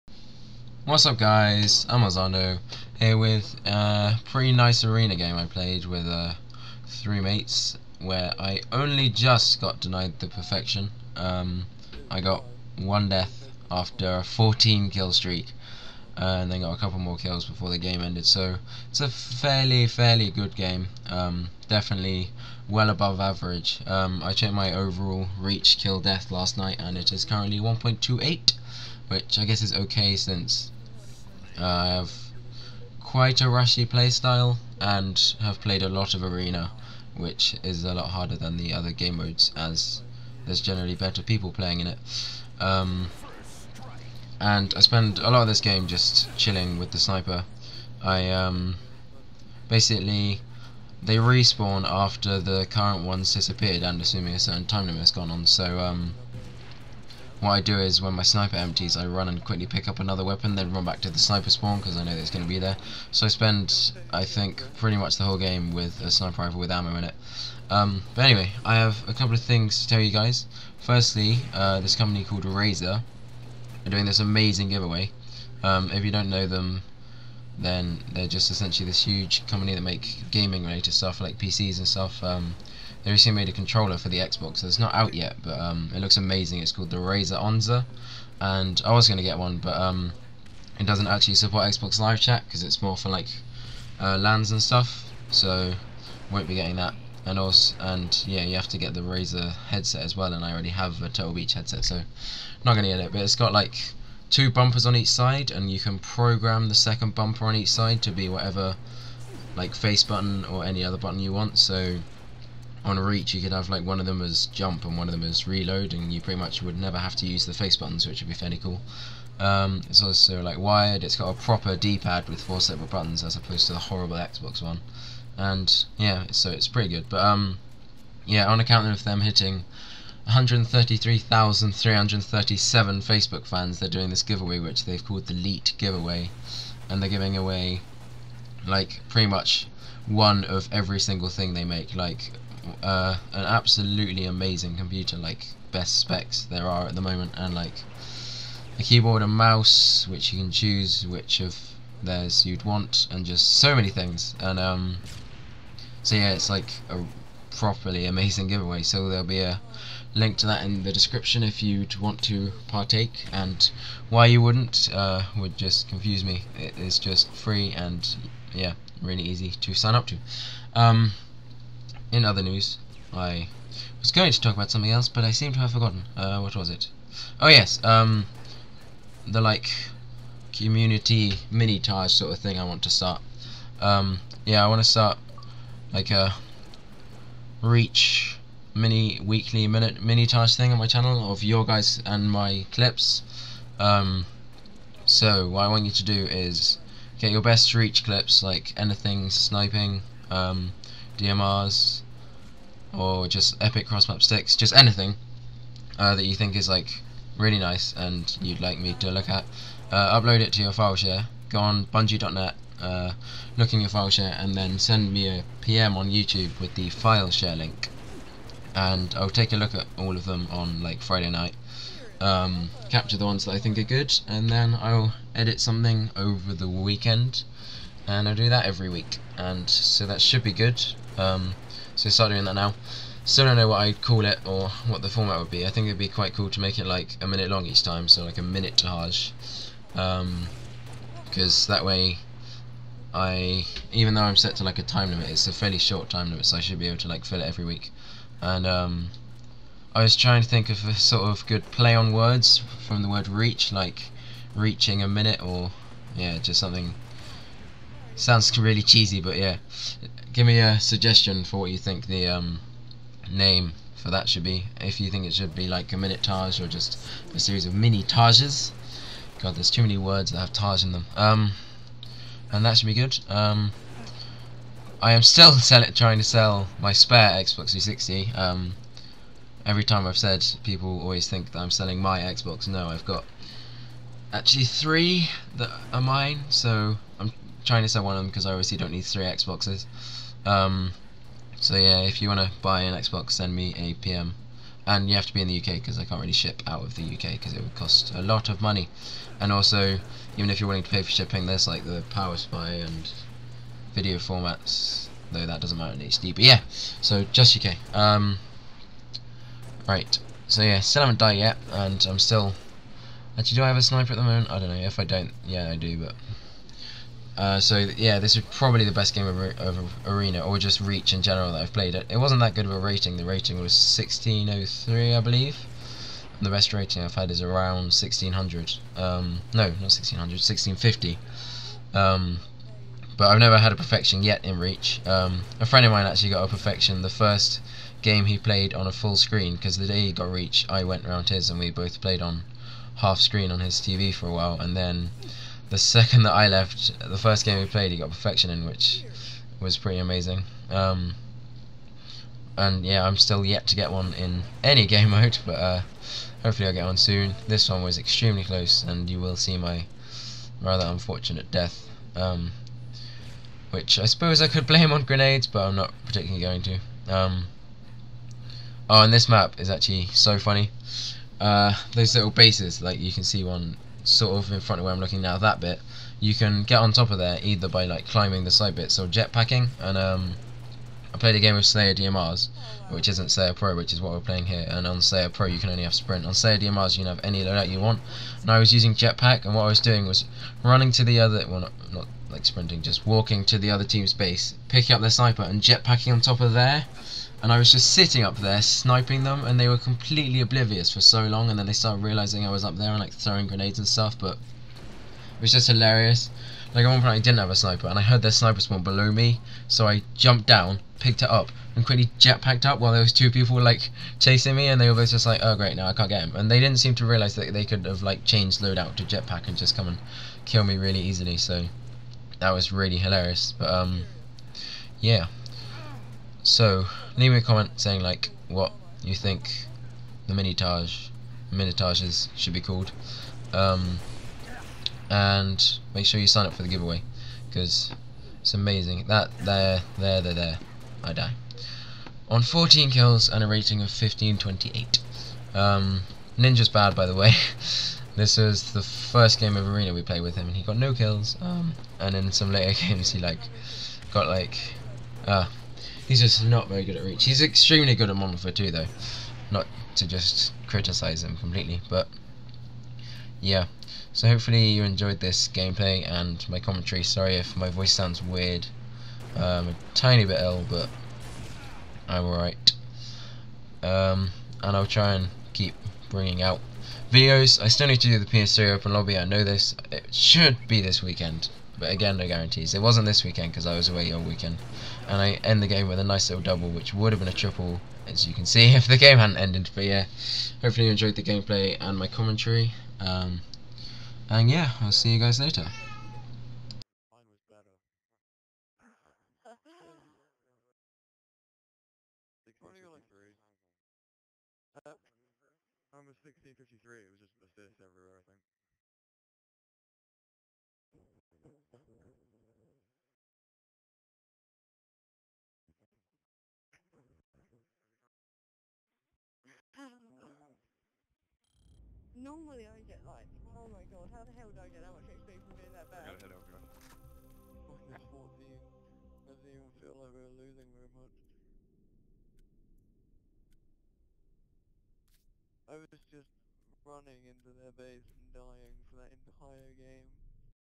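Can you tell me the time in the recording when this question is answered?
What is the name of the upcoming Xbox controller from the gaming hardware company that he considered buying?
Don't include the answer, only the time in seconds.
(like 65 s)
86 s.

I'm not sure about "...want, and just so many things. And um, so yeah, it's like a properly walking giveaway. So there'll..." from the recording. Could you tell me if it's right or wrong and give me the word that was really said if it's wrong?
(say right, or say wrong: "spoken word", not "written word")
wrong: "amazing", not "walking".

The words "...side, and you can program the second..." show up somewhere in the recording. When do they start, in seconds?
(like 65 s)
105 s.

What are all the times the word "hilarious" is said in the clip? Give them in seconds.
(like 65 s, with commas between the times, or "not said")
405 s, 422 s.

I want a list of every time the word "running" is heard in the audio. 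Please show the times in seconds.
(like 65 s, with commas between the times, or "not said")
390 s, 536 s.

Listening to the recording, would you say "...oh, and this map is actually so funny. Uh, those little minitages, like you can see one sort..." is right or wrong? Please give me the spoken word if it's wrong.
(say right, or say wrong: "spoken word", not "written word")
wrong: "bases", not "minitages".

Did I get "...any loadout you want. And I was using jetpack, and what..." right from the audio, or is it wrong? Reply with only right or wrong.
right.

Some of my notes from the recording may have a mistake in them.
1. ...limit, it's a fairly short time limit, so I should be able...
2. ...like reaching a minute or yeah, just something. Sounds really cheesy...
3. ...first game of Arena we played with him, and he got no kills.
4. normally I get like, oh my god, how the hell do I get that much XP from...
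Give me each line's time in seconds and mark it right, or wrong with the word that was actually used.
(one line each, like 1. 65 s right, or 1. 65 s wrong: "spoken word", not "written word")
1. 245 s right
2. 253 s right
3. 448 s right
4. 522 s right.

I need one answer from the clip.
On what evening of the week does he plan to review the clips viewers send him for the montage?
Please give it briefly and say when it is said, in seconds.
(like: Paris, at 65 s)
Friday night, at 221 s.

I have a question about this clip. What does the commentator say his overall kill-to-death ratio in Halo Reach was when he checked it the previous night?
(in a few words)
1.28.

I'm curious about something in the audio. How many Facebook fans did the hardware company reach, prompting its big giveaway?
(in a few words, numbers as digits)
133,337.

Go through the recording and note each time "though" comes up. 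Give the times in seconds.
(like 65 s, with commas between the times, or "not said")
244 s, 305 s, 458 s.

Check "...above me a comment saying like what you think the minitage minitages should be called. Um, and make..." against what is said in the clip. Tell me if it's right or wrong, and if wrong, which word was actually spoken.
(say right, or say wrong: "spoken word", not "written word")
wrong: "leave", not "above".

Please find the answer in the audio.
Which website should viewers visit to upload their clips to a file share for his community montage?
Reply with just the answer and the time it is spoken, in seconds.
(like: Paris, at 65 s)
Bungie.net, at 211 s.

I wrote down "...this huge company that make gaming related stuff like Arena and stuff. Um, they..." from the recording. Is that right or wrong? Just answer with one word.
wrong.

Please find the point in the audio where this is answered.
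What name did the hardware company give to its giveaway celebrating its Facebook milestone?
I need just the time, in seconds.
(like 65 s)
135 s.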